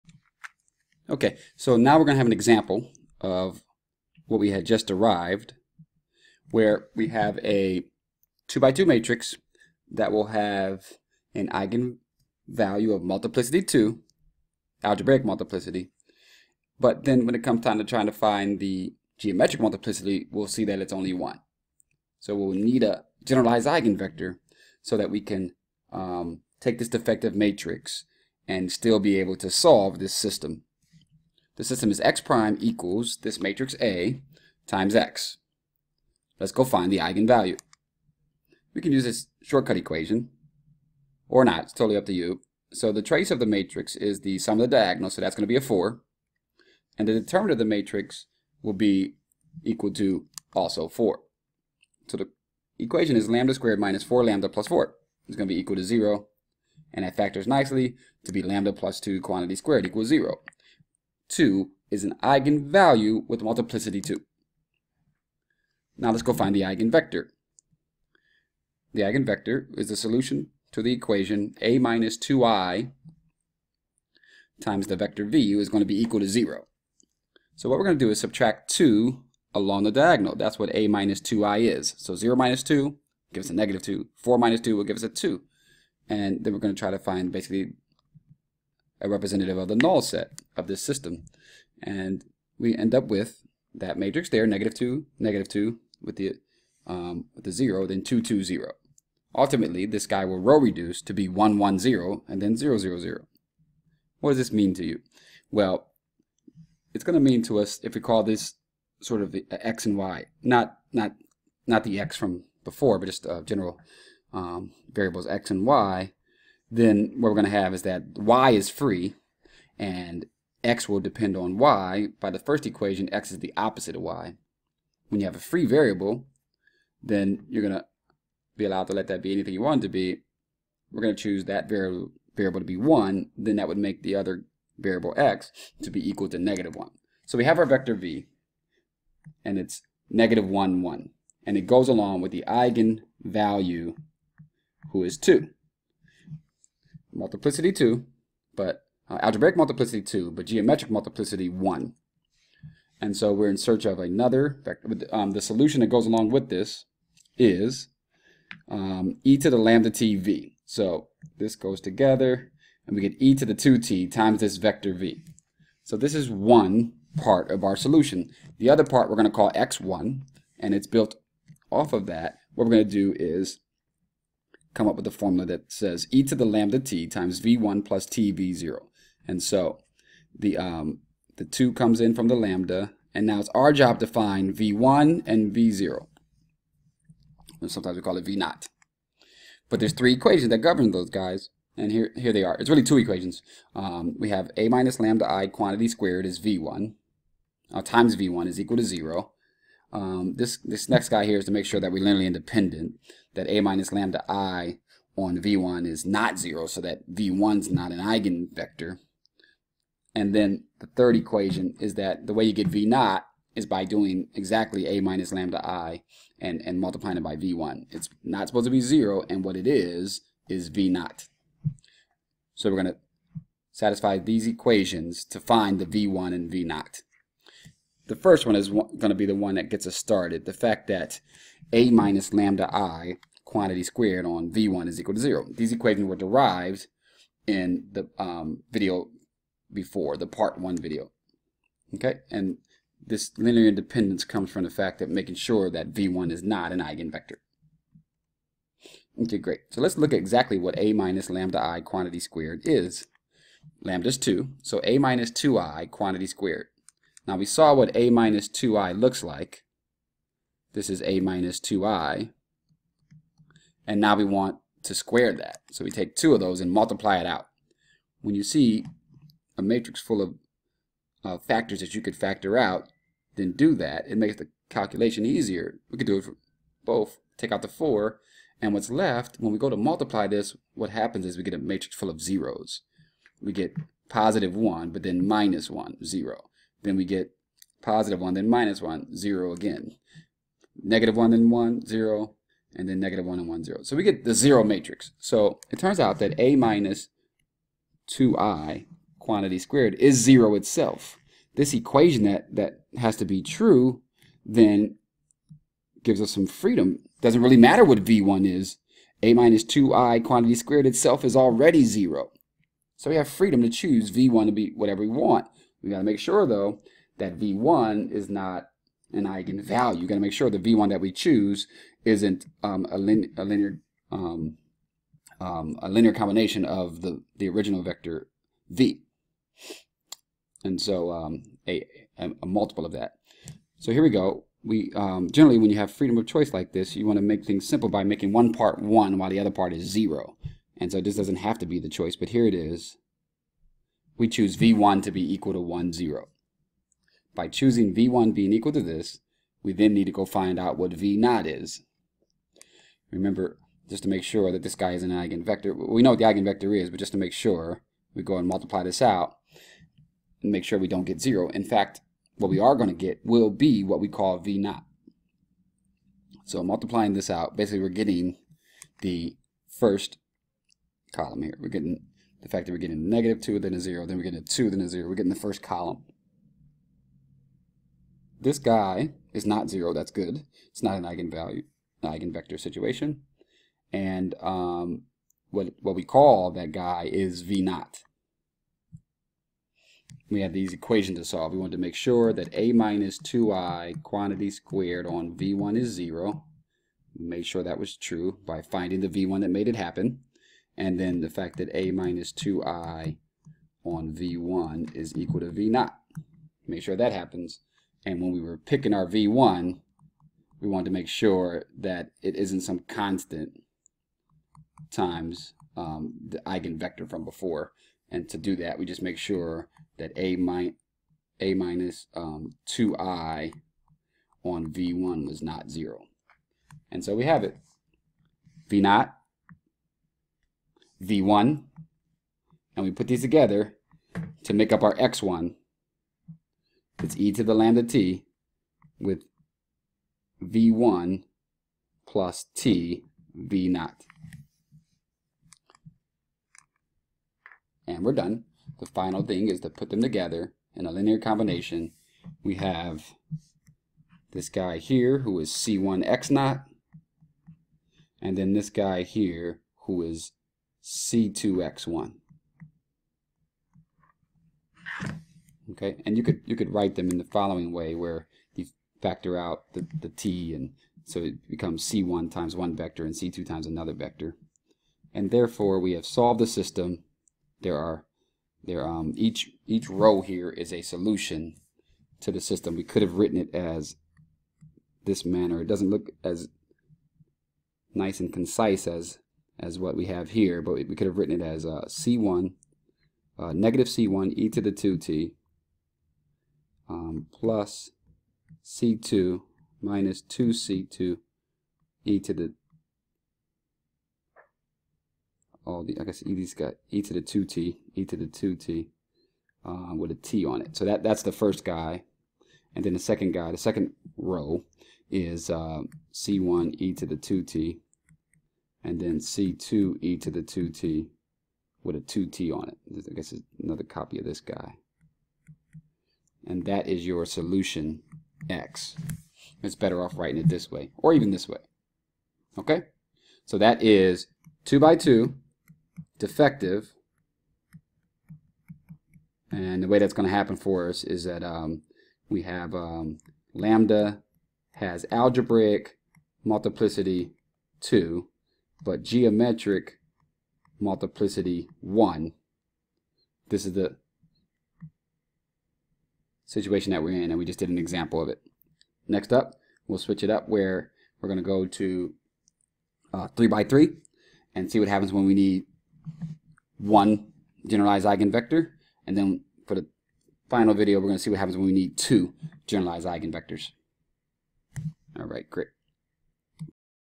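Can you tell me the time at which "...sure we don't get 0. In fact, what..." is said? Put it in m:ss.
6:00.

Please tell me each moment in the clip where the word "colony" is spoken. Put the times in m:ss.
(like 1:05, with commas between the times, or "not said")
not said.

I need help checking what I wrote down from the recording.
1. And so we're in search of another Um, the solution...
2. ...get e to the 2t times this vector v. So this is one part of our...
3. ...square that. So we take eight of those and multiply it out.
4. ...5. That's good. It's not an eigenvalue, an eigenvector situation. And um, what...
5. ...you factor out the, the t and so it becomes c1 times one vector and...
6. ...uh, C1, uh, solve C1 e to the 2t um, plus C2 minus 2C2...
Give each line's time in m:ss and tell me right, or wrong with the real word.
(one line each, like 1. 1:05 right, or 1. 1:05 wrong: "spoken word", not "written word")
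1. 2:32 right
2. 2:43 right
3. 4:24 wrong: "two", not "eight"
4. 6:19 wrong: "0", not "5"
5. 7:48 right
6. 8:11 wrong: "negative", not "solve".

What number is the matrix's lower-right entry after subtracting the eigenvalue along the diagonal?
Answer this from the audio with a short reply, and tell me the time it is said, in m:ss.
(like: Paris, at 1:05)
2, at 1:24.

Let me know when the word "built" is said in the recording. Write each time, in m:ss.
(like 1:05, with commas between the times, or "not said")
2:50.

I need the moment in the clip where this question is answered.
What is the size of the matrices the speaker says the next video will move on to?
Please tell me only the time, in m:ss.
9:23.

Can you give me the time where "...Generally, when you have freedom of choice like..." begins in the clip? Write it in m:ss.
5:35.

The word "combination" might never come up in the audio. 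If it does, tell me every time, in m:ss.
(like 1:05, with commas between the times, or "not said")
5:26, 7:31.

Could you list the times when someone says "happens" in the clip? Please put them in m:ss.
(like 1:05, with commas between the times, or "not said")
4:40, 6:39, 6:47, 9:00, 9:24, 9:31.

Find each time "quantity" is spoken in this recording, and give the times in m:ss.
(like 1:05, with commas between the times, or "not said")
0:59, 3:15, 3:53, 4:11, 4:15, 4:59, 5:10, 6:34.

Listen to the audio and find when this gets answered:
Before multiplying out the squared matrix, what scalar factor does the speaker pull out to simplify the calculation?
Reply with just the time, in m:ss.
4:37.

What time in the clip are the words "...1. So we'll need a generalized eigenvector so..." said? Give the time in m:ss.
0:21.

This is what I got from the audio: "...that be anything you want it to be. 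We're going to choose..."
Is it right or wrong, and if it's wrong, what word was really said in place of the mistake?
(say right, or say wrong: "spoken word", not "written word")
right.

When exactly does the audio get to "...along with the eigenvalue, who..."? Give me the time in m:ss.
2:21.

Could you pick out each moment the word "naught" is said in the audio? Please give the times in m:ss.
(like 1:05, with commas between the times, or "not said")
6:27, 7:08.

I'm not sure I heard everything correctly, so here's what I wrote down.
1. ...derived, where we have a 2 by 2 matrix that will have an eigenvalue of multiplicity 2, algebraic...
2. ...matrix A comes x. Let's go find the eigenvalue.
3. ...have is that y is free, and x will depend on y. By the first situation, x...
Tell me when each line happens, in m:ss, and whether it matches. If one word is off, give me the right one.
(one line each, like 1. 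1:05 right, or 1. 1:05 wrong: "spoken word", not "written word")
1. 0:04 right
2. 0:33 wrong: "times", not "comes"
3. 1:57 wrong: "equation", not "situation".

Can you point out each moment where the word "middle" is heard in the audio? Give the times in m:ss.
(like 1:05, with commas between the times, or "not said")
not said.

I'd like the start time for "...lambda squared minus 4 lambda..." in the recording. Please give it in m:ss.
0:53.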